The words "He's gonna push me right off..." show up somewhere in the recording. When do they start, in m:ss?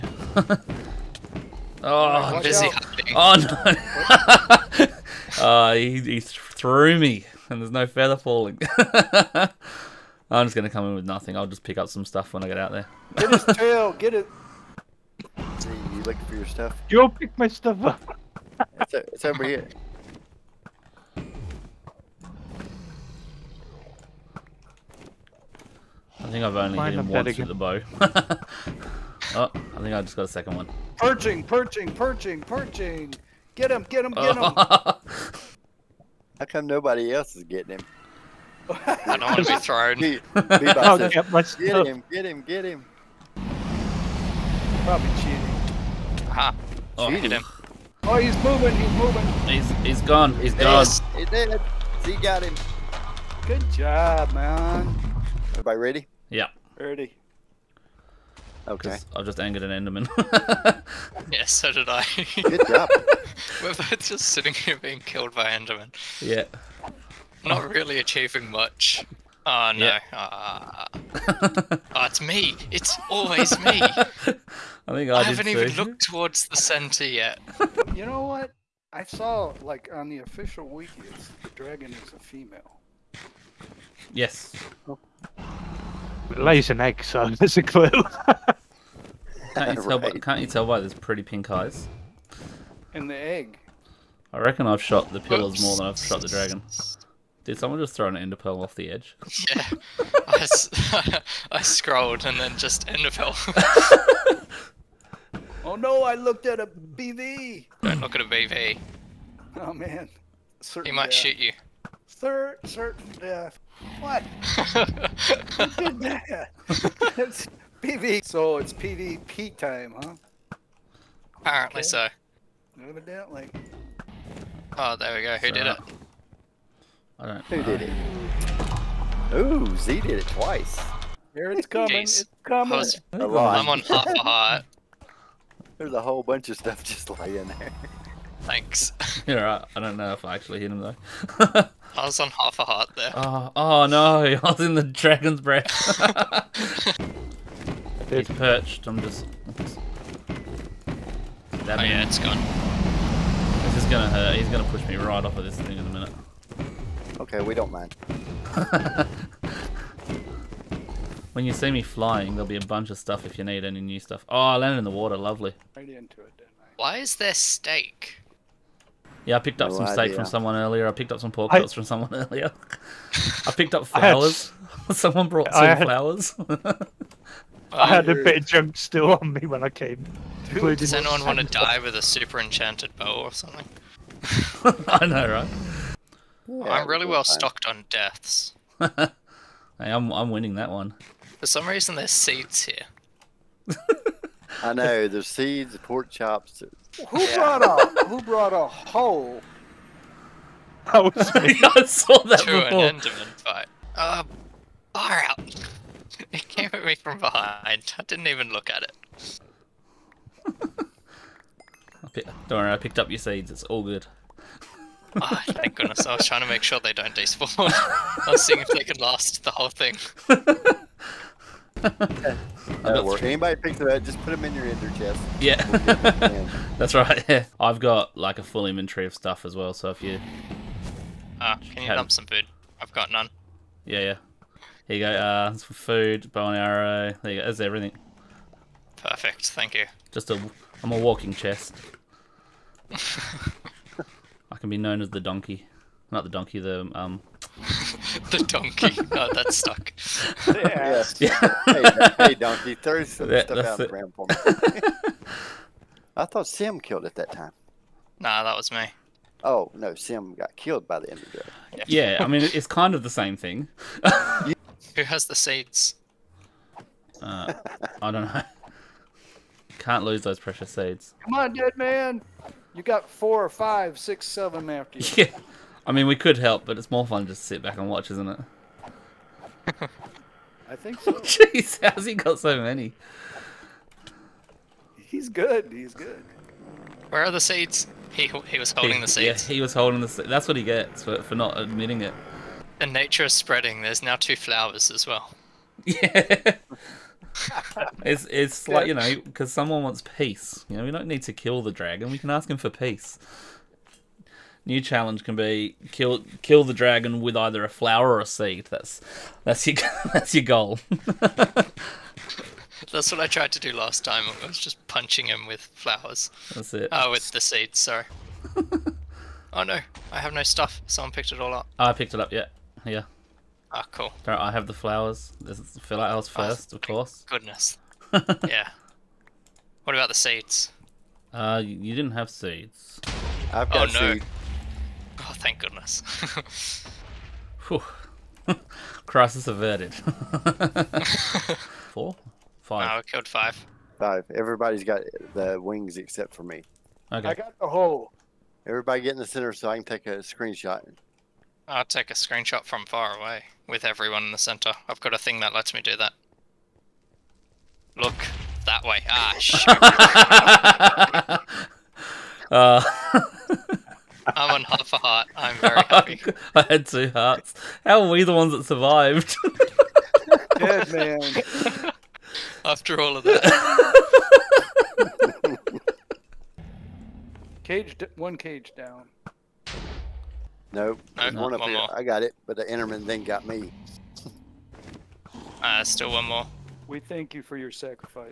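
2:34.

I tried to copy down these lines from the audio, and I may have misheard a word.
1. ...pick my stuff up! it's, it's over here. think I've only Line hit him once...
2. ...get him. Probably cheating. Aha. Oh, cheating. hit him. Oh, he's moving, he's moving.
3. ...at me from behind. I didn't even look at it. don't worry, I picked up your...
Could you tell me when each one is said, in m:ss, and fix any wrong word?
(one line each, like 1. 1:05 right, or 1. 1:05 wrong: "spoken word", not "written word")
1. 0:17 right
2. 0:42 right
3. 3:26 right.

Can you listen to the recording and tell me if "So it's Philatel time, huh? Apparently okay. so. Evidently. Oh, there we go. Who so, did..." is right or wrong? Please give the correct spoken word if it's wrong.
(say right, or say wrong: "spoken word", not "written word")
wrong: "PvP", not "Philatel".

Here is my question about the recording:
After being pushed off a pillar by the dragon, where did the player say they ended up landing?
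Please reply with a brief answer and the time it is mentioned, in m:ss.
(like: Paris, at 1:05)
Water, at 2:44.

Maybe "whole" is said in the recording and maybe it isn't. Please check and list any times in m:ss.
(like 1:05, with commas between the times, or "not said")
2:15, 3:39.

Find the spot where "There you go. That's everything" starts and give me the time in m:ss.
3:57.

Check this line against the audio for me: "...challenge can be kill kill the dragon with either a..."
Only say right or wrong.
right.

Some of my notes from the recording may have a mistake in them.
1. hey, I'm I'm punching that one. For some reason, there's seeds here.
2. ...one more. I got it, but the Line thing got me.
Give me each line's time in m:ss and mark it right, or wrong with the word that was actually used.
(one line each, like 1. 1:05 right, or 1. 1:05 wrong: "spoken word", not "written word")
1. 3:08 wrong: "winning", not "punching"
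2. 6:21 wrong: "Enderman", not "Line".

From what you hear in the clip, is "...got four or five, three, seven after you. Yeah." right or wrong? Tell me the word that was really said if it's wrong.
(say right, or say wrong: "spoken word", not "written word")
wrong: "six", not "three".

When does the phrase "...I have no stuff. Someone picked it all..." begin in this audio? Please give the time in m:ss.
5:20.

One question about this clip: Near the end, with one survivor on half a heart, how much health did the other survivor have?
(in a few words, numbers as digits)
2 hearts.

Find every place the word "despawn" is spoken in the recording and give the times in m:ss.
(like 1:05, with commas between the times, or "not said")
3:37.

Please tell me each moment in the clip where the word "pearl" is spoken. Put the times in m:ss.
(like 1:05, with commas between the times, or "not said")
1:38, 1:43.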